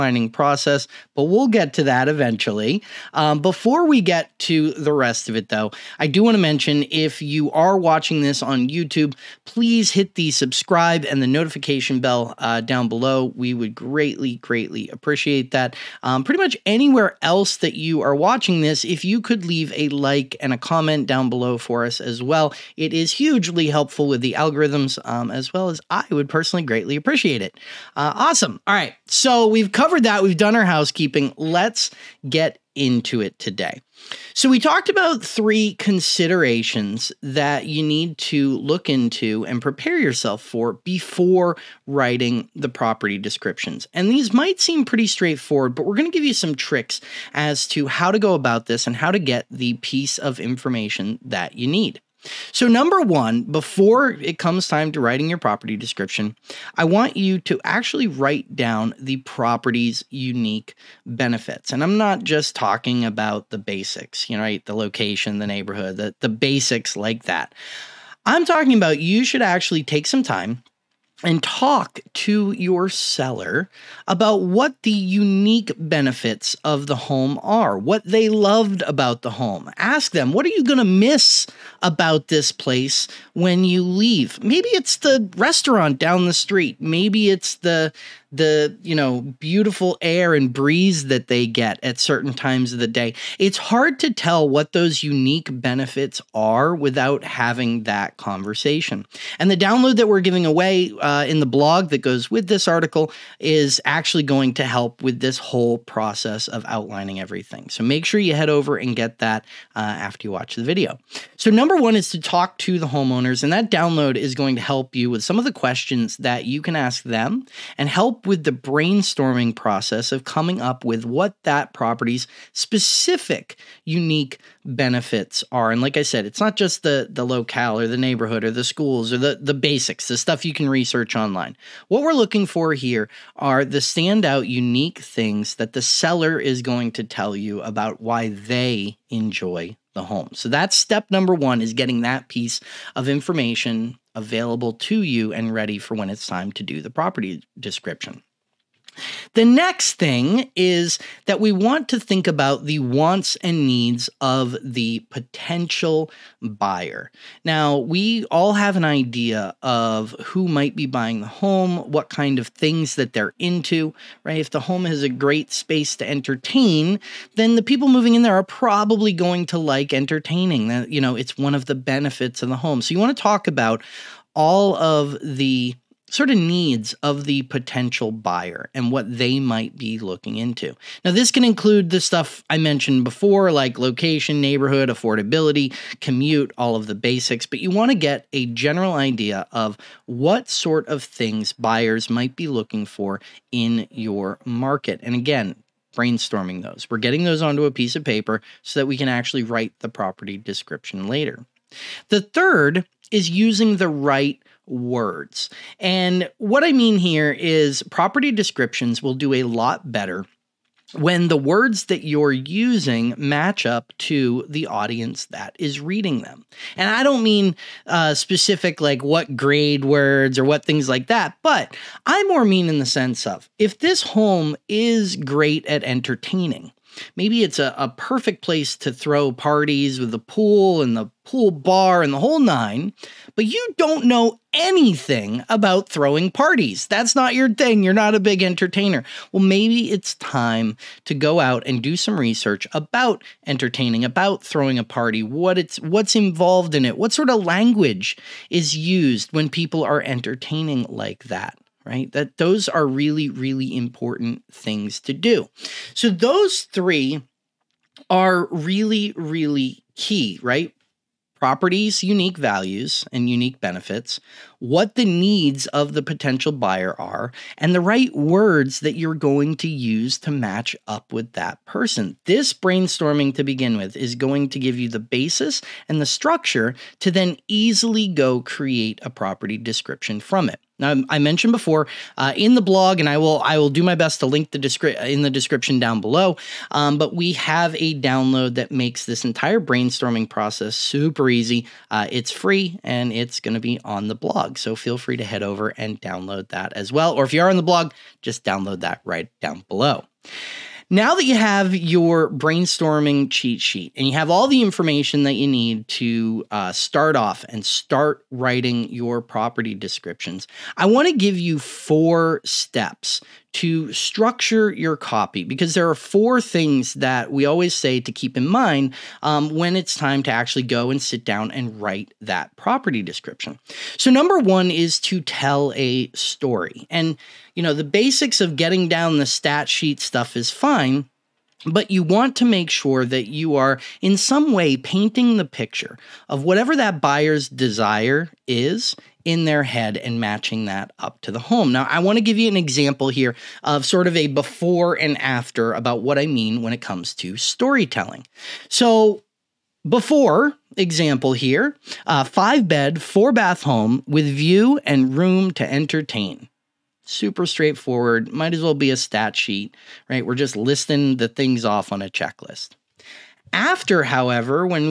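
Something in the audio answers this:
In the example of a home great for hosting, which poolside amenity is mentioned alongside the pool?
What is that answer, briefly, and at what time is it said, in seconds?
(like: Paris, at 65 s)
Pool bar, at 231 s.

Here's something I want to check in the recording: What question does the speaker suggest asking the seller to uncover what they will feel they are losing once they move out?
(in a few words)
What are you going to miss about this place.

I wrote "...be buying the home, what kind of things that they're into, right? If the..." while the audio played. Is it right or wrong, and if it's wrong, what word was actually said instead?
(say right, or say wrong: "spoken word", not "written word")
right.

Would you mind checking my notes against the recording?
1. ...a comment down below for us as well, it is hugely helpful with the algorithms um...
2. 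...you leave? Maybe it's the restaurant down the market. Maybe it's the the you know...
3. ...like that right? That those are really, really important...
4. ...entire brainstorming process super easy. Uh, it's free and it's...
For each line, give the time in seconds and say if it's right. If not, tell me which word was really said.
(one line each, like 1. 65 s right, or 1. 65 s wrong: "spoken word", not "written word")
1. 20 s right
2. 83 s wrong: "street", not "market"
3. 250 s right
4. 289 s right.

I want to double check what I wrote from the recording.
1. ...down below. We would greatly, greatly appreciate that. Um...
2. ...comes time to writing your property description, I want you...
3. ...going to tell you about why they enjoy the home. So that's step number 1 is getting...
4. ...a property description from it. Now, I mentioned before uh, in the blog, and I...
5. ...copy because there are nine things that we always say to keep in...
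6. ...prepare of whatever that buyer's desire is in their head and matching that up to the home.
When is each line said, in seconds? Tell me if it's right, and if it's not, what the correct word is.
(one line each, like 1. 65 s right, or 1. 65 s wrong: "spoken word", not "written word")
1. 12 s right
2. 54 s right
3. 136 s right
4. 279 s right
5. 314 s wrong: "four", not "nine"
6. 335 s wrong: "picture", not "prepare".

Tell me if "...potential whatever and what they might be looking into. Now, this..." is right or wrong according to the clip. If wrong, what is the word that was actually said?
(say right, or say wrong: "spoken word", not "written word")
wrong: "buyer", not "whatever".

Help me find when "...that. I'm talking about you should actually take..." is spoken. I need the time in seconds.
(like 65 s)
67 s.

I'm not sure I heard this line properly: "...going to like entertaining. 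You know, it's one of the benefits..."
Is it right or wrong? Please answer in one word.
right.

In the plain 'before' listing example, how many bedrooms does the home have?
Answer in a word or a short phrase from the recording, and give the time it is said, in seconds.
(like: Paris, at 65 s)
5, at 352 s.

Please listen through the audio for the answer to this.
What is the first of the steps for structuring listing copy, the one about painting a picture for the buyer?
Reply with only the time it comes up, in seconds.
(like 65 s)
325 s.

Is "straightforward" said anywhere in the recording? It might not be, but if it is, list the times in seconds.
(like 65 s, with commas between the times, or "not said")
45 s, 357 s.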